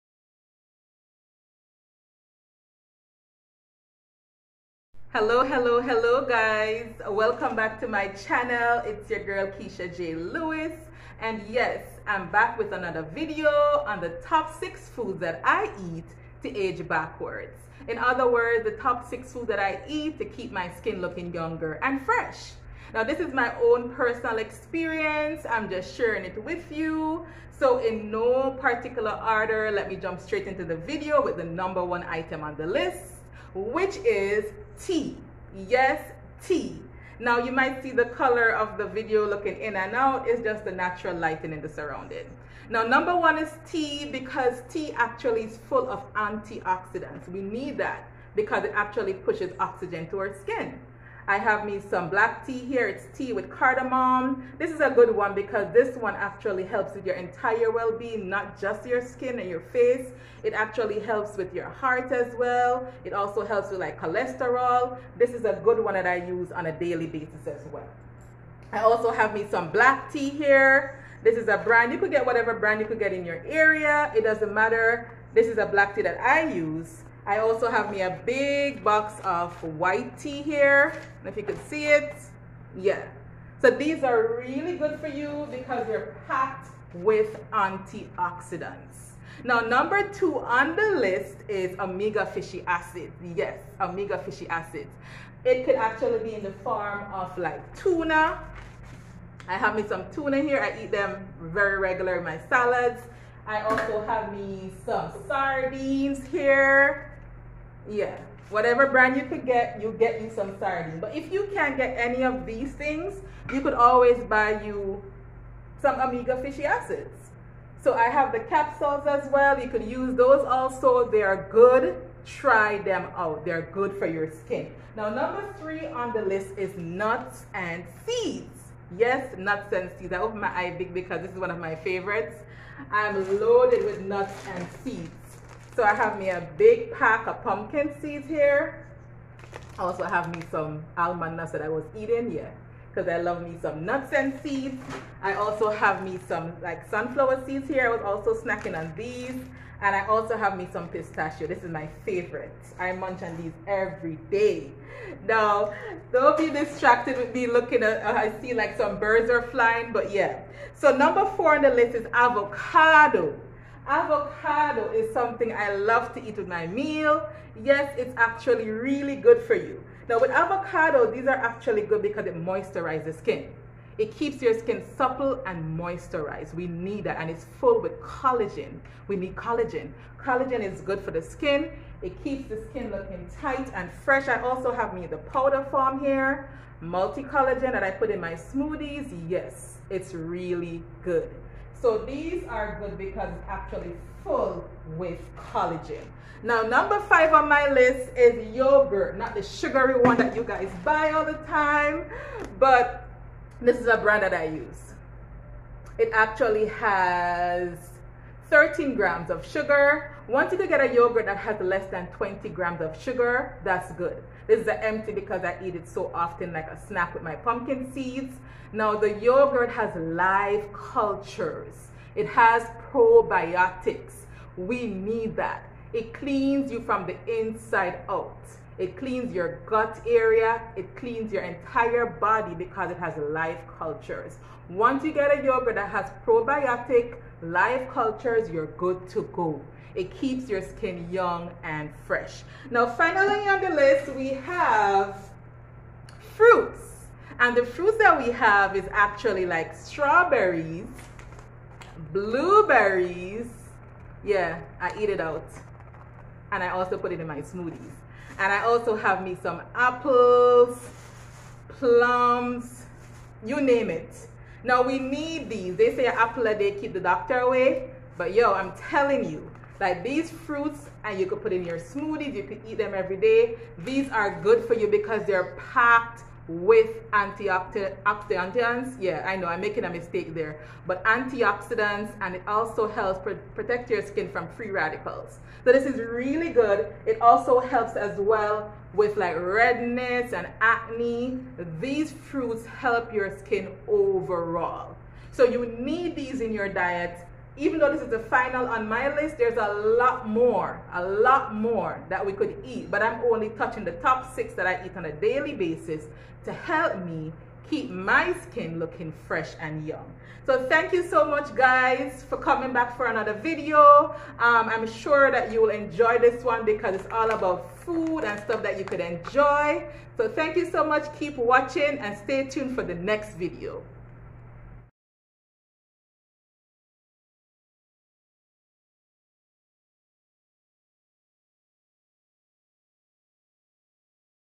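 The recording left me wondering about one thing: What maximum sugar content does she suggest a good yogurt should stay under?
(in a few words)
20 grams.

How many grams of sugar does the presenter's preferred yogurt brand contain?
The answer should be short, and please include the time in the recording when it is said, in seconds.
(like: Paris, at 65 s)
13 grams, at 208 s.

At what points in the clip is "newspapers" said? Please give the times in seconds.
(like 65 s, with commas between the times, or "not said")
not said.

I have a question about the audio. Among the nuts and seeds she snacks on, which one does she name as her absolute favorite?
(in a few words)
pistachio.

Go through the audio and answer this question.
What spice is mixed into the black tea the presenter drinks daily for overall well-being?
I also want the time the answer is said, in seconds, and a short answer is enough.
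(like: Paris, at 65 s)
cardamom, at 53 s.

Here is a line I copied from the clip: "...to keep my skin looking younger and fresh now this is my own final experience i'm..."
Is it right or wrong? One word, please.
wrong.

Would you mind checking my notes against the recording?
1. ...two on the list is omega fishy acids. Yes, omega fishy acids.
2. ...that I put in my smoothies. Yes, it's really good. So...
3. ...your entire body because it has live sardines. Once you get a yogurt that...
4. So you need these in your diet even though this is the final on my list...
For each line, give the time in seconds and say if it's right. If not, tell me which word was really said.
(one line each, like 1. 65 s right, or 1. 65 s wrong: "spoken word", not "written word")
1. 90 s right
2. 187 s right
3. 231 s wrong: "cultures", not "sardines"
4. 295 s right.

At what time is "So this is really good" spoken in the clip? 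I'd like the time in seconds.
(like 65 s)
285 s.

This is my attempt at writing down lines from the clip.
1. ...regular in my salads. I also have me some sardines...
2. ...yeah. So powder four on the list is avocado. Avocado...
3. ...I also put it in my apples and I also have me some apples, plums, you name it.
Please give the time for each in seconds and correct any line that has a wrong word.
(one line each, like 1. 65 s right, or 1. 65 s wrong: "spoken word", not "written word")
1. 101 s right
2. 160 s wrong: "number", not "powder"
3. 256 s wrong: "smoothies", not "apples".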